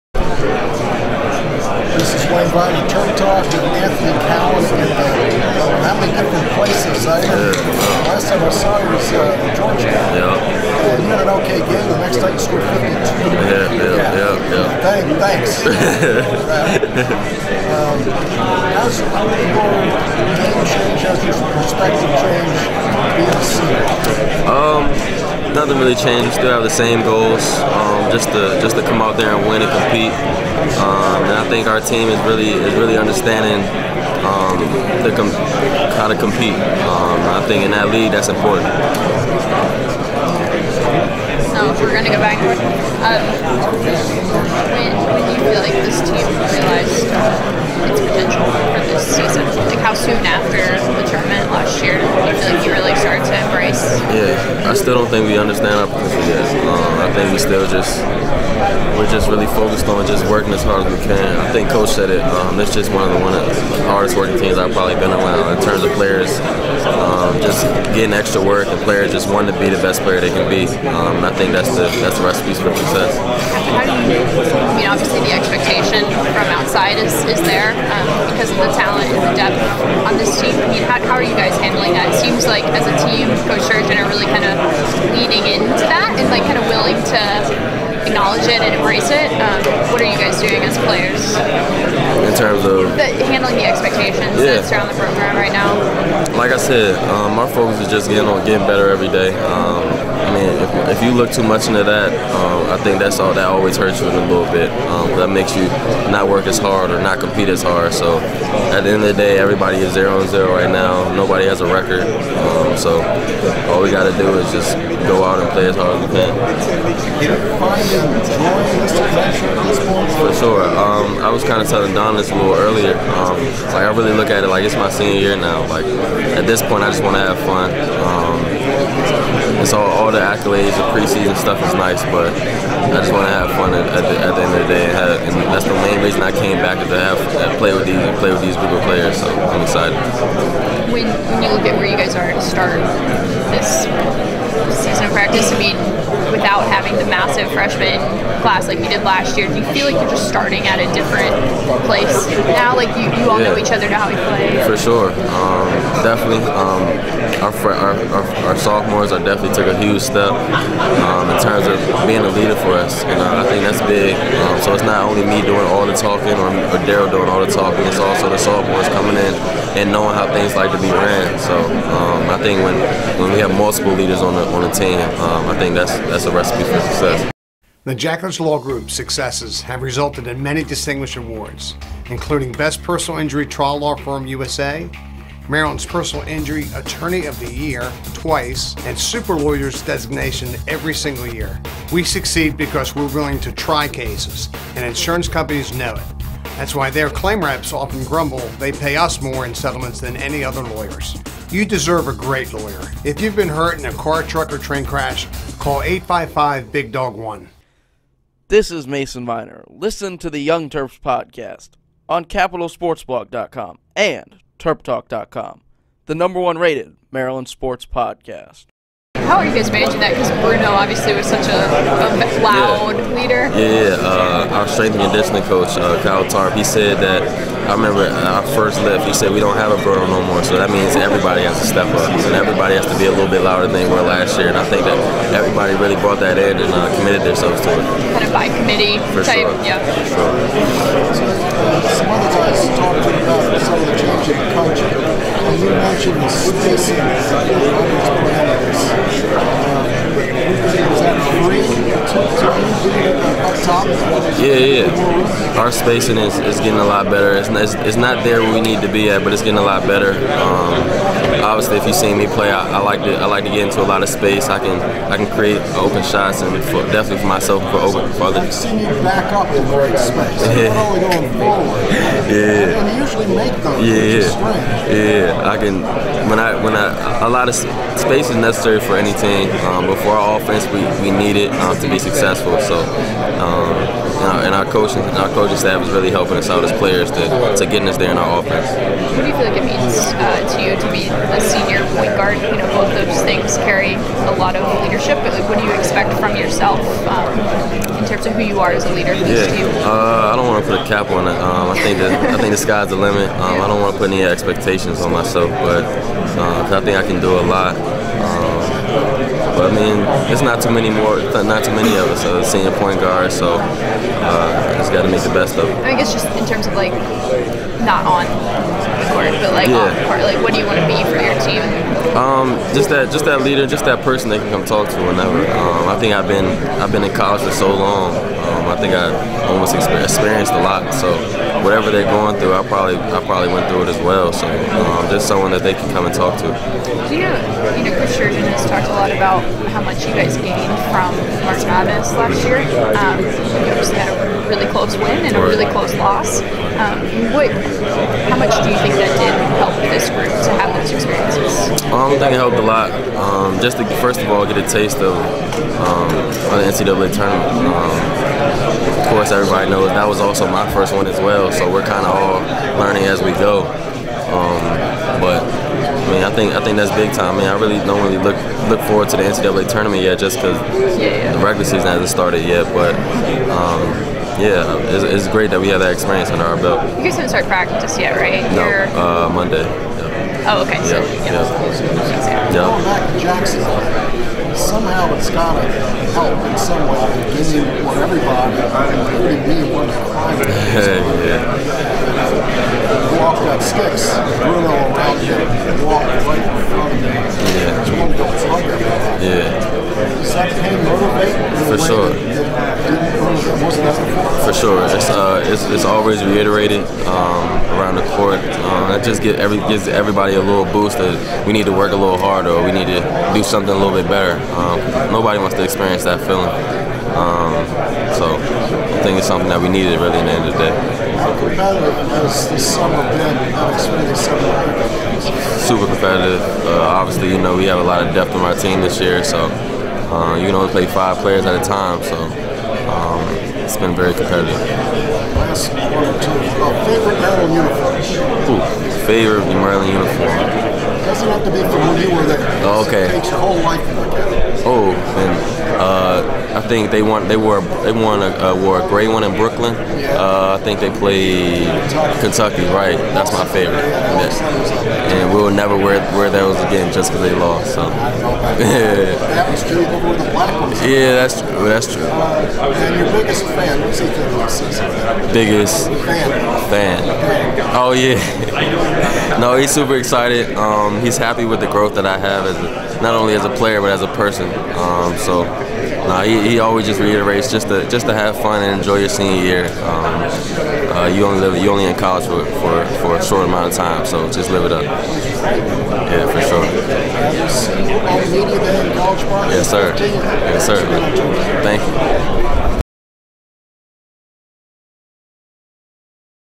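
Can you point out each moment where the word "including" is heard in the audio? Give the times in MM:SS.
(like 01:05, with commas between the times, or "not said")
03:02, 06:28.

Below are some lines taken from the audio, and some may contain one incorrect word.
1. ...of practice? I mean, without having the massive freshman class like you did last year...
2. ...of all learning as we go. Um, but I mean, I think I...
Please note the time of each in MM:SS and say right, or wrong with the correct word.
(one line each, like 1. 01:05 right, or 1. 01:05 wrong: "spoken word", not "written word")
1. 02:25 right
2. 06:02 right.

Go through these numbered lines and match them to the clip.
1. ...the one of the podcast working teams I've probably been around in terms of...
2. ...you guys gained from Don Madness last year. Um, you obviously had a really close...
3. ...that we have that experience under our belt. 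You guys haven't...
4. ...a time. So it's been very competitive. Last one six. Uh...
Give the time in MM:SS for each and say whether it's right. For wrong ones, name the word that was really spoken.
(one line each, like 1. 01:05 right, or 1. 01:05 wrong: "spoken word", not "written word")
1. 01:03 wrong: "hardest", not "podcast"
2. 05:40 wrong: "March", not "Don"
3. 06:15 right
4. 07:11 wrong: "two", not "six".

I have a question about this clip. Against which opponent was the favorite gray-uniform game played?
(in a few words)
Kentucky.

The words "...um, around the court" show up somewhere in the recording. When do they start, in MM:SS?
06:47.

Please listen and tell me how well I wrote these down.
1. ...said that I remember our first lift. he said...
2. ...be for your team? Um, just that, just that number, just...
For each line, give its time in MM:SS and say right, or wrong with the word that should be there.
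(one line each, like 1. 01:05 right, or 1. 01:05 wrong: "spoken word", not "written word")
1. 03:46 right
2. 05:20 wrong: "leader", not "number".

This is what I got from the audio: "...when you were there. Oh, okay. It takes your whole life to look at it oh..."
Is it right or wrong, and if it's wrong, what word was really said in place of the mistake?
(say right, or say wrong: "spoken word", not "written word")
right.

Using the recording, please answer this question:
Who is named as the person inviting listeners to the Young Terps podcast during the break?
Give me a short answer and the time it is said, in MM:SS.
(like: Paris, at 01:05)
Mason Viener, at 03:28.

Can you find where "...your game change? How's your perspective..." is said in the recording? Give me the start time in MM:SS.
00:18.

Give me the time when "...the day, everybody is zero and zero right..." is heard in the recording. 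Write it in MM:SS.
01:49.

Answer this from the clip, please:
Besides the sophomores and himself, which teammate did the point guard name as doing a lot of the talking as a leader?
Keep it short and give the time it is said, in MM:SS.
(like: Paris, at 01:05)
Darryl, at 02:46.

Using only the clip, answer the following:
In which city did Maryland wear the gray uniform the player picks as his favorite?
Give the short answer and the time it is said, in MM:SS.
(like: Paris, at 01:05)
Brooklyn, at 07:29.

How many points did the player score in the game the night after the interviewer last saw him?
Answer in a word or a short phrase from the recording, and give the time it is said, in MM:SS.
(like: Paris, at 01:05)
52, at 00:12.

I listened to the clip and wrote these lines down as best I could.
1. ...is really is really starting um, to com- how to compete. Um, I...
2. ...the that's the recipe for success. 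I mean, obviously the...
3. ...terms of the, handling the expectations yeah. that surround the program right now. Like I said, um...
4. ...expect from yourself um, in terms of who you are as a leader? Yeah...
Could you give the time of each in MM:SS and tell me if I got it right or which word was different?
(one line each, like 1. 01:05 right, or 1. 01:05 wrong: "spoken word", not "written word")
1. 00:32 wrong: "understanding", not "starting"
2. 01:11 right
3. 01:32 right
4. 04:55 right.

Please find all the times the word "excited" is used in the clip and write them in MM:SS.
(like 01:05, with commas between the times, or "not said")
02:19, 07:49.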